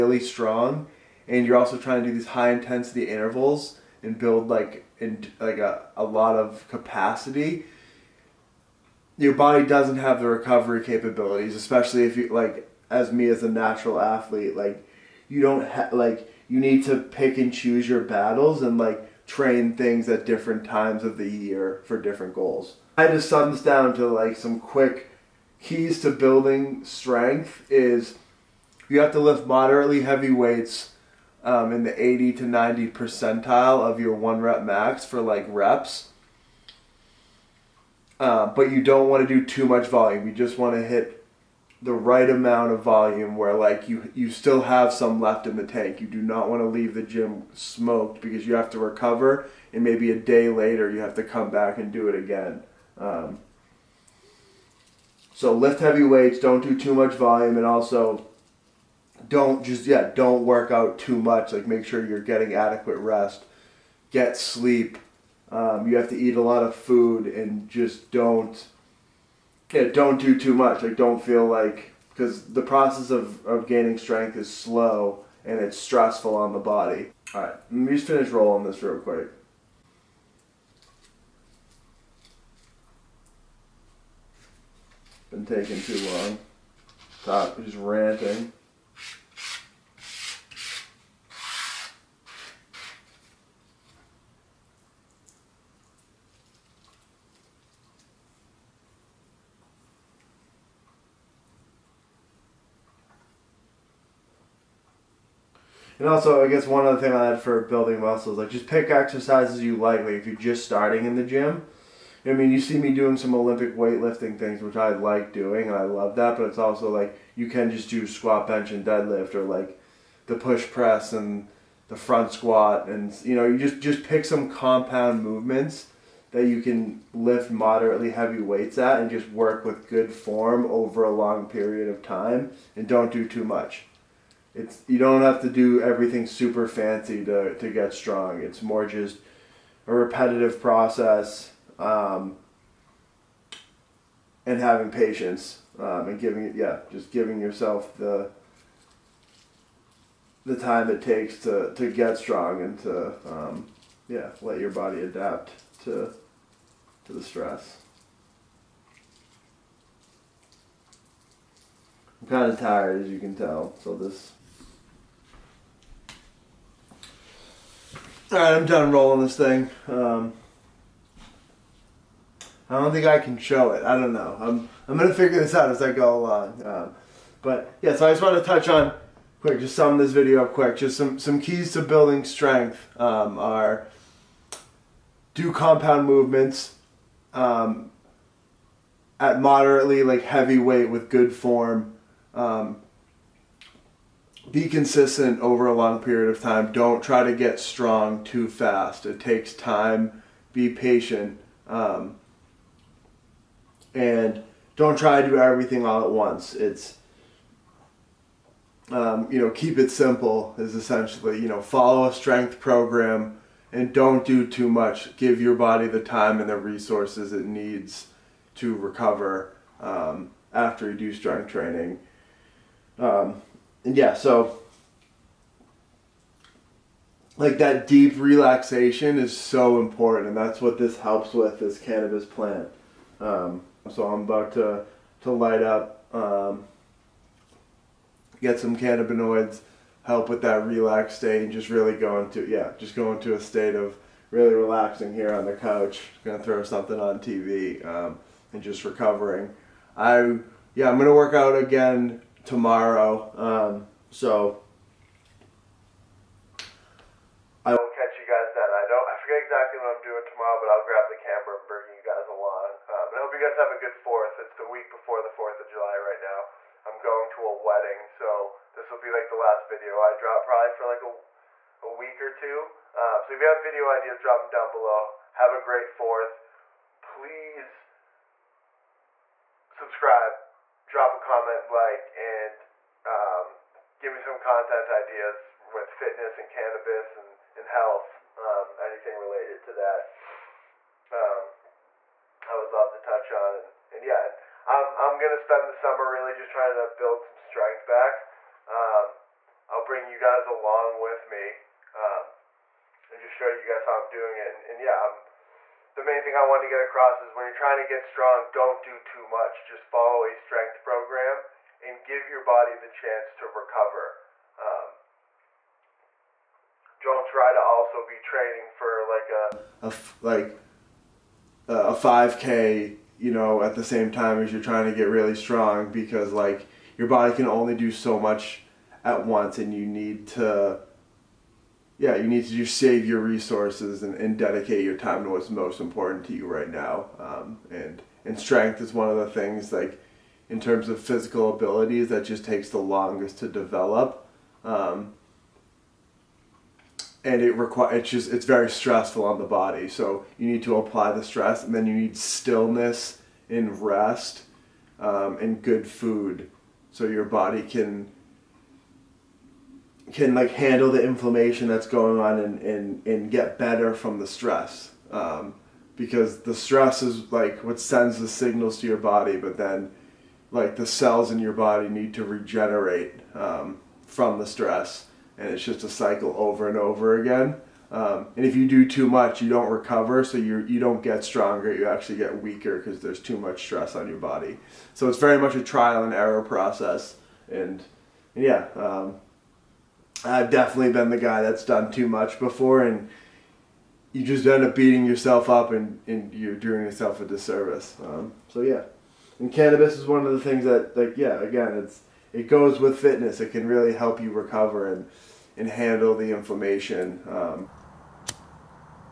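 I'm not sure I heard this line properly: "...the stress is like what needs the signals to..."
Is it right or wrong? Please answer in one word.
wrong.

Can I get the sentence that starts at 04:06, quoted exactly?
Gonna throw something on TV um, and just recovering.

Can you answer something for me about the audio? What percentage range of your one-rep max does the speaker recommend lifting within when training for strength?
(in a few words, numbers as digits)
80 to 90.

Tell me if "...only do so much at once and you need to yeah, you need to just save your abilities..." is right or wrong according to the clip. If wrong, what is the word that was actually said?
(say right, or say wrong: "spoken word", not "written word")
wrong: "resources", not "abilities".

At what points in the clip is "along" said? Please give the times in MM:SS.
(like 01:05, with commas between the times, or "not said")
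02:56, 04:22, 05:00.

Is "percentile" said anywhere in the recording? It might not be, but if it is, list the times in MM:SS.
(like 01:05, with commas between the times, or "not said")
00:32.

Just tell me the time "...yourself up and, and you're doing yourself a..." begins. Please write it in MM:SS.
06:35.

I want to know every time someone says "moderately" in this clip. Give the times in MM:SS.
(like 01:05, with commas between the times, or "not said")
00:29, 02:07, 03:09.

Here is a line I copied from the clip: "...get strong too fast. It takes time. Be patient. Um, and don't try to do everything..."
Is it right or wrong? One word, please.
right.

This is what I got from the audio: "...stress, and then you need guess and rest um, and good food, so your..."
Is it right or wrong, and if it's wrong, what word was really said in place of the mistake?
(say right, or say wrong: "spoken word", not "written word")
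wrong: "stillness", not "guess".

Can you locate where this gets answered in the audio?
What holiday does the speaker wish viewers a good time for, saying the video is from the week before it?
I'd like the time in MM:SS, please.
04:25.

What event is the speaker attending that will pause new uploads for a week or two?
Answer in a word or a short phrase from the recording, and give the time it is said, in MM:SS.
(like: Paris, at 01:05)
a wedding, at 04:27.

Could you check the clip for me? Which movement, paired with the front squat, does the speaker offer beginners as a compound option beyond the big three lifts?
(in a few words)
push press.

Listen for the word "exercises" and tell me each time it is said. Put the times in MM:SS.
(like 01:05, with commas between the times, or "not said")
01:48.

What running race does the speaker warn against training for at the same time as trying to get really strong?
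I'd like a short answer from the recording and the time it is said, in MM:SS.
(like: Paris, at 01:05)
5k, at 05:21.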